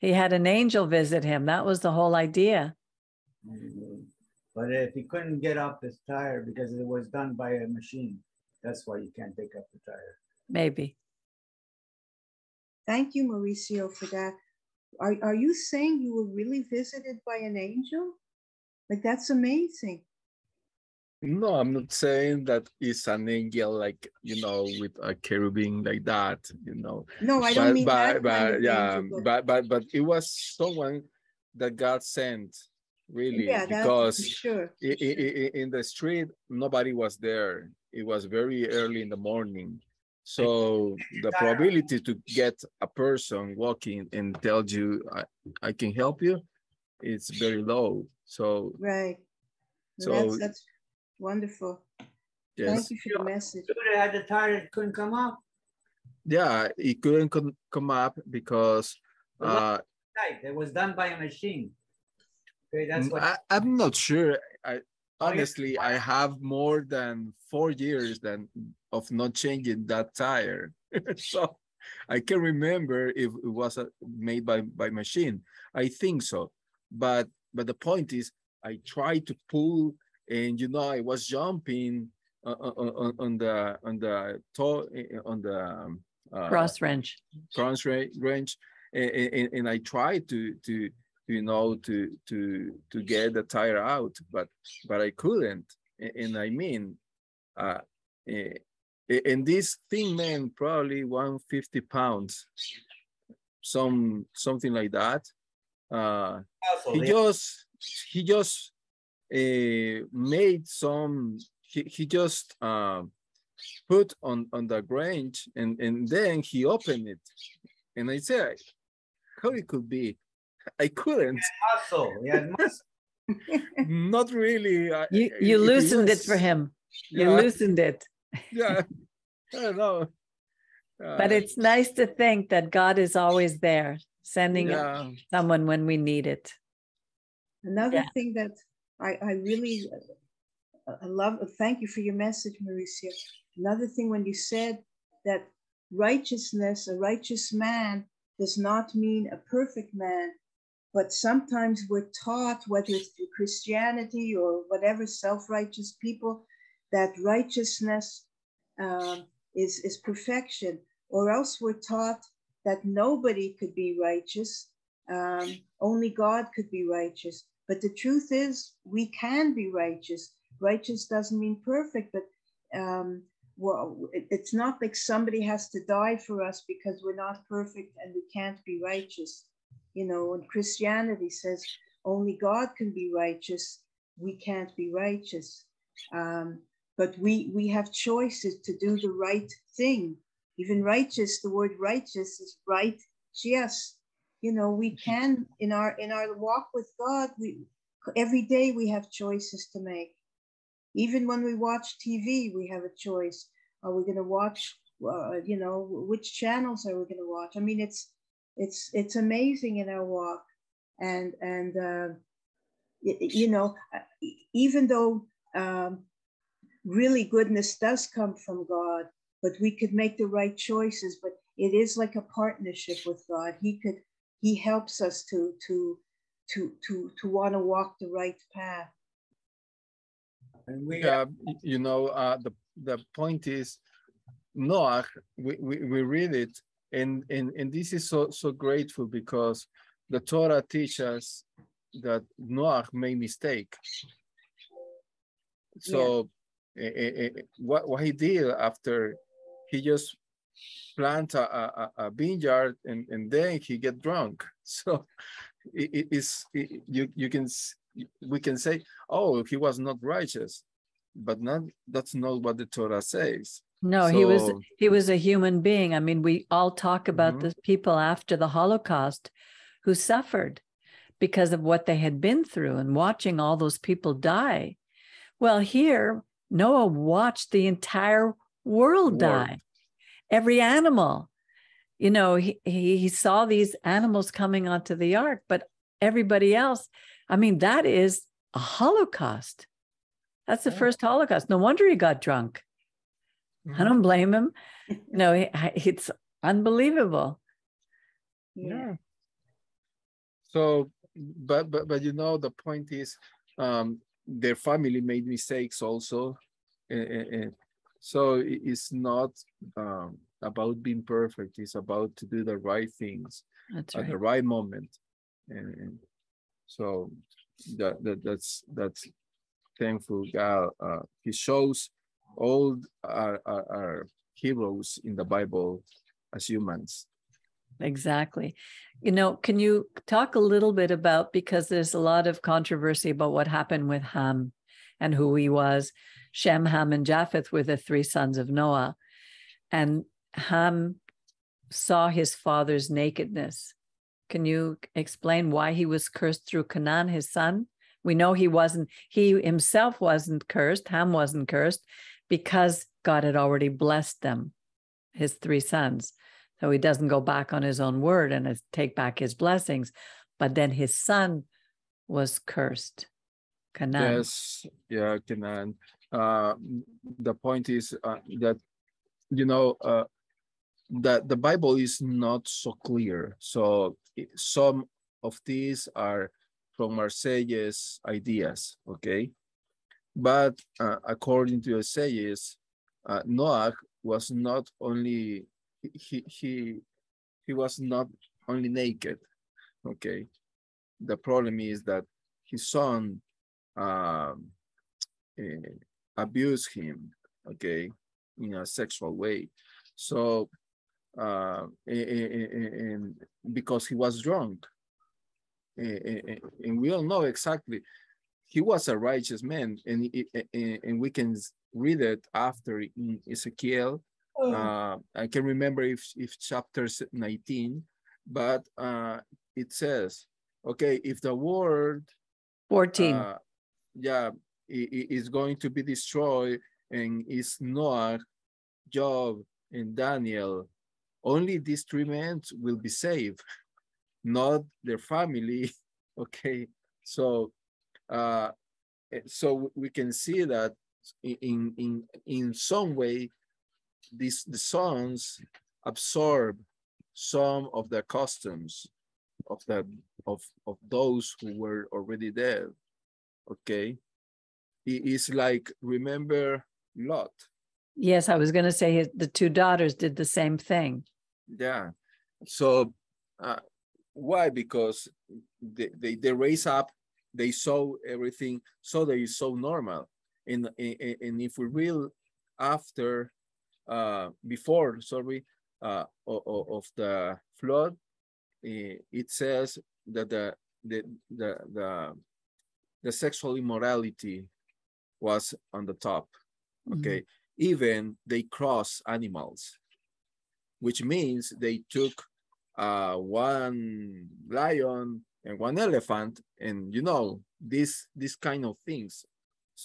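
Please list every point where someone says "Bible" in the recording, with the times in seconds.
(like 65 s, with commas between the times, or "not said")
325 s, 371 s.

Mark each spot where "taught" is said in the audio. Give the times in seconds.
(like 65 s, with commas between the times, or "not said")
152 s, 161 s.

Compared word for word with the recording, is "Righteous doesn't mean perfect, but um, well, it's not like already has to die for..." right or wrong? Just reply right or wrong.
wrong.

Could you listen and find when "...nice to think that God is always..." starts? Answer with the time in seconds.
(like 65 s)
131 s.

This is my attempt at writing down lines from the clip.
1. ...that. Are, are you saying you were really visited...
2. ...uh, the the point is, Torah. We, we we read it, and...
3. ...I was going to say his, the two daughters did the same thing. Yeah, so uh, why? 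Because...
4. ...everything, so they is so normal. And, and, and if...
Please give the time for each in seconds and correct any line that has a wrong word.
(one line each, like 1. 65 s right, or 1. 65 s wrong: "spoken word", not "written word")
1. 14 s right
2. 232 s wrong: "Noah", not "Torah"
3. 458 s right
4. 468 s right.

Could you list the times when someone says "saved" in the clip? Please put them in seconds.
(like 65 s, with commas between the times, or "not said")
432 s.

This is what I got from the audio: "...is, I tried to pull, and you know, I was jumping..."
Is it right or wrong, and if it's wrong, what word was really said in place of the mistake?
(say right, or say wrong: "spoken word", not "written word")
right.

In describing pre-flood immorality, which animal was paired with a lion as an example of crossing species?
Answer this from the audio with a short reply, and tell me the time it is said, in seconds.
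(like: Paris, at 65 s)
Elephant, at 495 s.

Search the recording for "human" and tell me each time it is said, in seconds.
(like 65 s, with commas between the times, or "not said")
265 s, 326 s.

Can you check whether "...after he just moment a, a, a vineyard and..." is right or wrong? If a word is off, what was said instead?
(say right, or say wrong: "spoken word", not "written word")
wrong: "plant", not "moment".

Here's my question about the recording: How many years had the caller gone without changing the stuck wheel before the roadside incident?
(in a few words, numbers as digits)
4.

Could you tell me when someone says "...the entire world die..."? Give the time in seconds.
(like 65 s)
277 s.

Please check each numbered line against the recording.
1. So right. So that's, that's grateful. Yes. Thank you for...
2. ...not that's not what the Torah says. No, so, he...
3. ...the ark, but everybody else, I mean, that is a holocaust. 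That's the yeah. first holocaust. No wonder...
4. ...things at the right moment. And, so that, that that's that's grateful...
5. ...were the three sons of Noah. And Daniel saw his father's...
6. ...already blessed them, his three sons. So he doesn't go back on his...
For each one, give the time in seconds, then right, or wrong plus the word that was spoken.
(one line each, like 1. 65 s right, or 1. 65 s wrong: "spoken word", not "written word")
1. 48 s wrong: "wonderful", not "grateful"
2. 261 s right
3. 284 s right
4. 312 s wrong: "thankful", not "grateful"
5. 337 s wrong: "Ham", not "Daniel"
6. 353 s right.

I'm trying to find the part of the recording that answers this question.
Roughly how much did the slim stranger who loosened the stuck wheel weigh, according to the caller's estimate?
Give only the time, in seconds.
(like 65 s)
101 s.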